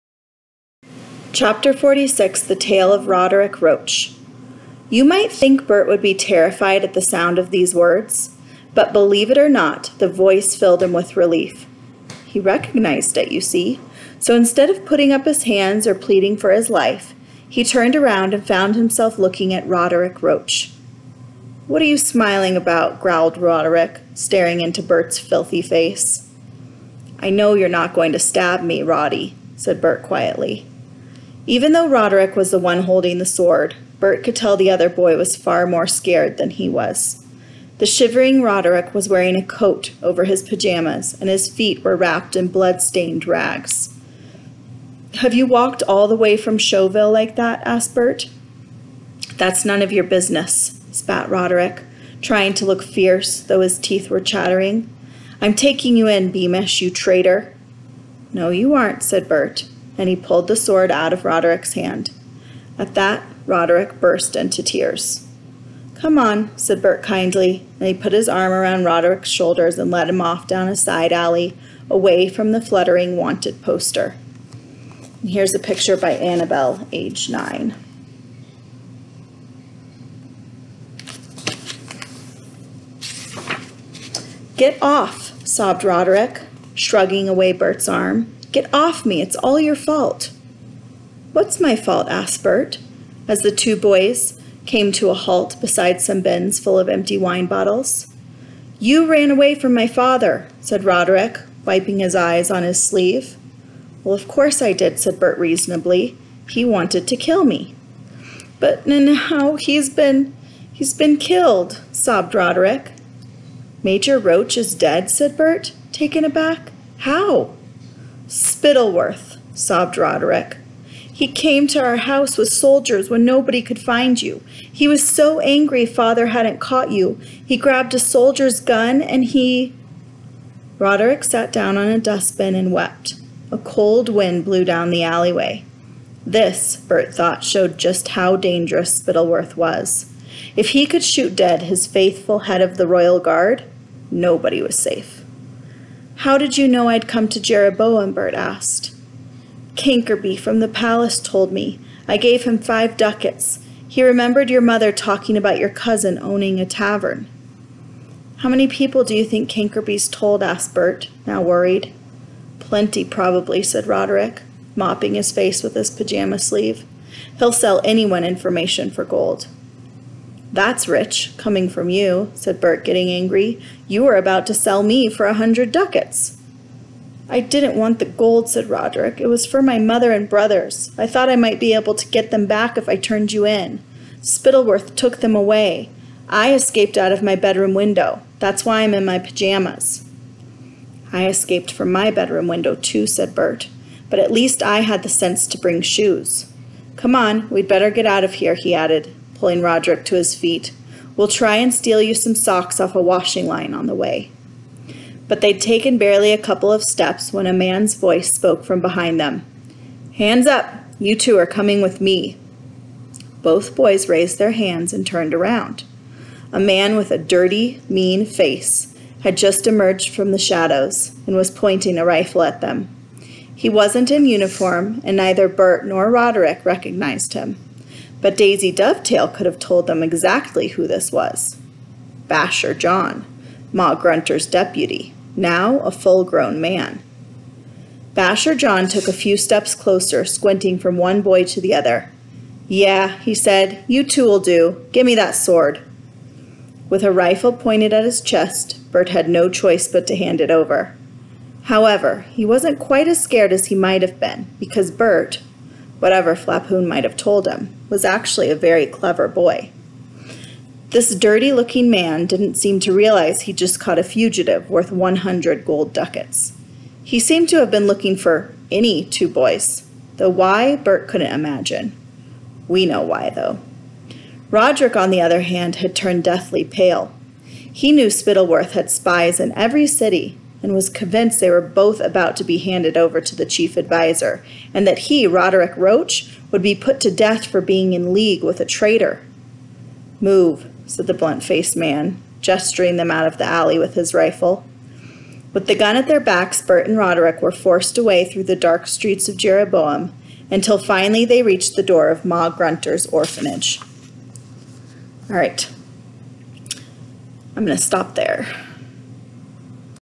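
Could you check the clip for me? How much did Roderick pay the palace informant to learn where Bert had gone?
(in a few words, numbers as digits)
5 ducats.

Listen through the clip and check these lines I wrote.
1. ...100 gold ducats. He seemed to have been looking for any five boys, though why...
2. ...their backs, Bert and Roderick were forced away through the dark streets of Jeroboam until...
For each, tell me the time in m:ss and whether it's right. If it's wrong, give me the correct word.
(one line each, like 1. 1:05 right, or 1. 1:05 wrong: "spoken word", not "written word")
1. 4:24 wrong: "two", not "five"
2. 4:56 right.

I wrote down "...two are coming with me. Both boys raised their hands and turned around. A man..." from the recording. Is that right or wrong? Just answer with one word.
right.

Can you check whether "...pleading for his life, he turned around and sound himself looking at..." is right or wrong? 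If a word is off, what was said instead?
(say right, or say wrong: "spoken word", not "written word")
wrong: "found", not "sound".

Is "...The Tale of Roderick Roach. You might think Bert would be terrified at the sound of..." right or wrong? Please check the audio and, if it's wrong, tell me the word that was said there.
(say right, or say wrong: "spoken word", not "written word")
right.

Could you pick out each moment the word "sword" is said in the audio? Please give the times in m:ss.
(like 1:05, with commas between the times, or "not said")
0:33, 1:00, 4:05.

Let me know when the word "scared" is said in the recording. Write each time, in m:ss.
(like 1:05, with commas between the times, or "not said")
0:35, 4:13.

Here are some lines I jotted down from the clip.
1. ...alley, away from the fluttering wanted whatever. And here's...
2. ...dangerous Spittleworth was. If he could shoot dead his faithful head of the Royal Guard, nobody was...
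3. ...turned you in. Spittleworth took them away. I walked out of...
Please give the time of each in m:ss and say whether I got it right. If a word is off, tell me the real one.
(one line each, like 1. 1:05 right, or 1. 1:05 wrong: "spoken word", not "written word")
1. 1:11 wrong: "poster", not "whatever"
2. 2:18 right
3. 3:02 wrong: "escaped", not "walked".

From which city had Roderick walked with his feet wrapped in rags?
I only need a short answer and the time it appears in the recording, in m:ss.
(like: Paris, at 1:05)
Chouxville, at 0:46.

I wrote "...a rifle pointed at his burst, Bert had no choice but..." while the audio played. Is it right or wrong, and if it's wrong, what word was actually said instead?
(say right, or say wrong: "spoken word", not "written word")
wrong: "chest", not "burst".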